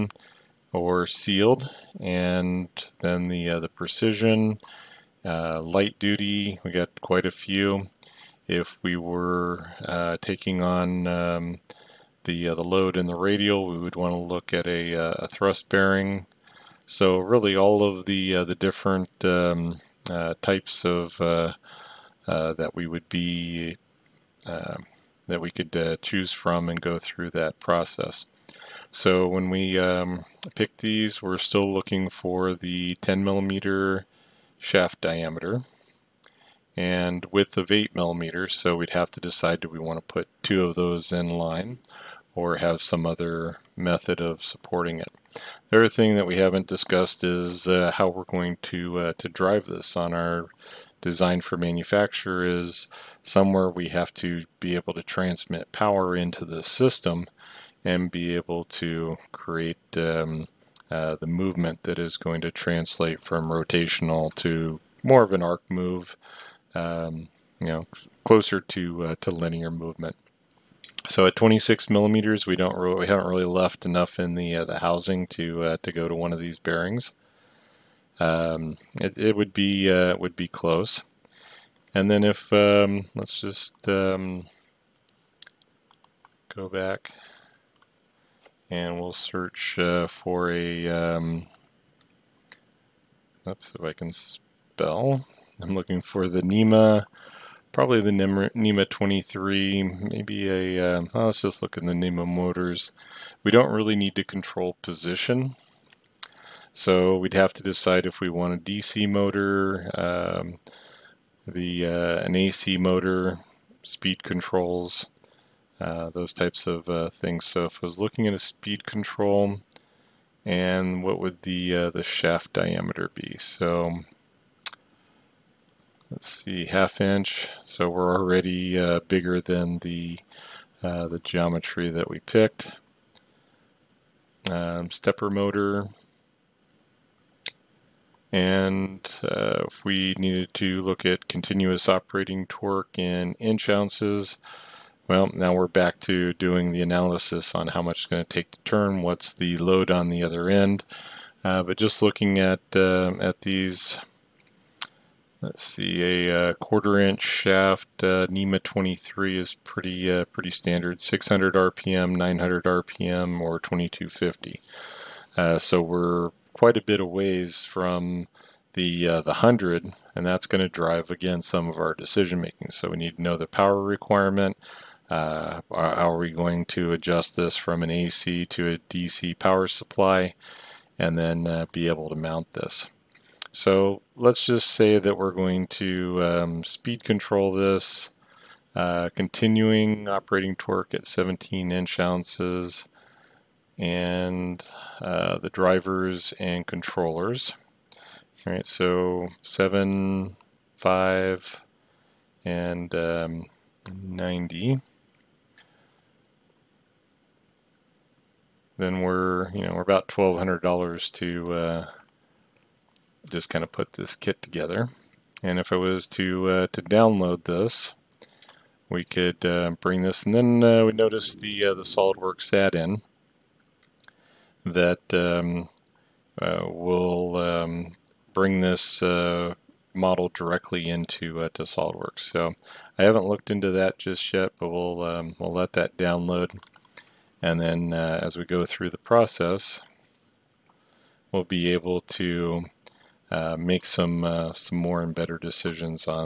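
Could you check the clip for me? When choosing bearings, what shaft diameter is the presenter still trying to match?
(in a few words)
10 millimeters.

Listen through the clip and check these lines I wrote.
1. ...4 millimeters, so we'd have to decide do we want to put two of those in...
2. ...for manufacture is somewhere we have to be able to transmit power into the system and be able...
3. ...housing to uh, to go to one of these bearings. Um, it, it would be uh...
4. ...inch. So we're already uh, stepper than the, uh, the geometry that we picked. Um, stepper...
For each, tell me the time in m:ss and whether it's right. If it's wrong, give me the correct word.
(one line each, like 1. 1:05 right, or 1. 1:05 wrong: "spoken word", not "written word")
1. 0:37 wrong: "8", not "4"
2. 0:51 right
3. 1:14 right
4. 2:07 wrong: "bigger", not "stepper".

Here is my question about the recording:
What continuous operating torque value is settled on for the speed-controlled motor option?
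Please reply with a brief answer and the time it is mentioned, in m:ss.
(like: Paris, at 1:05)
17 inch ounces, at 3:11.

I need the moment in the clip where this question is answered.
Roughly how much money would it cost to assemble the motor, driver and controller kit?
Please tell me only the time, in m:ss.
3:30.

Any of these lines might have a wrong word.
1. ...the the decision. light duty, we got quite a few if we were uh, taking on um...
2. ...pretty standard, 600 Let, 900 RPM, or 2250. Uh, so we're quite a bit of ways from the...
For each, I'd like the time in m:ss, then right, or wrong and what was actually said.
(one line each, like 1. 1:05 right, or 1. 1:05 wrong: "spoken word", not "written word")
1. 0:03 wrong: "precision", not "decision"
2. 2:40 wrong: "RPM", not "Let".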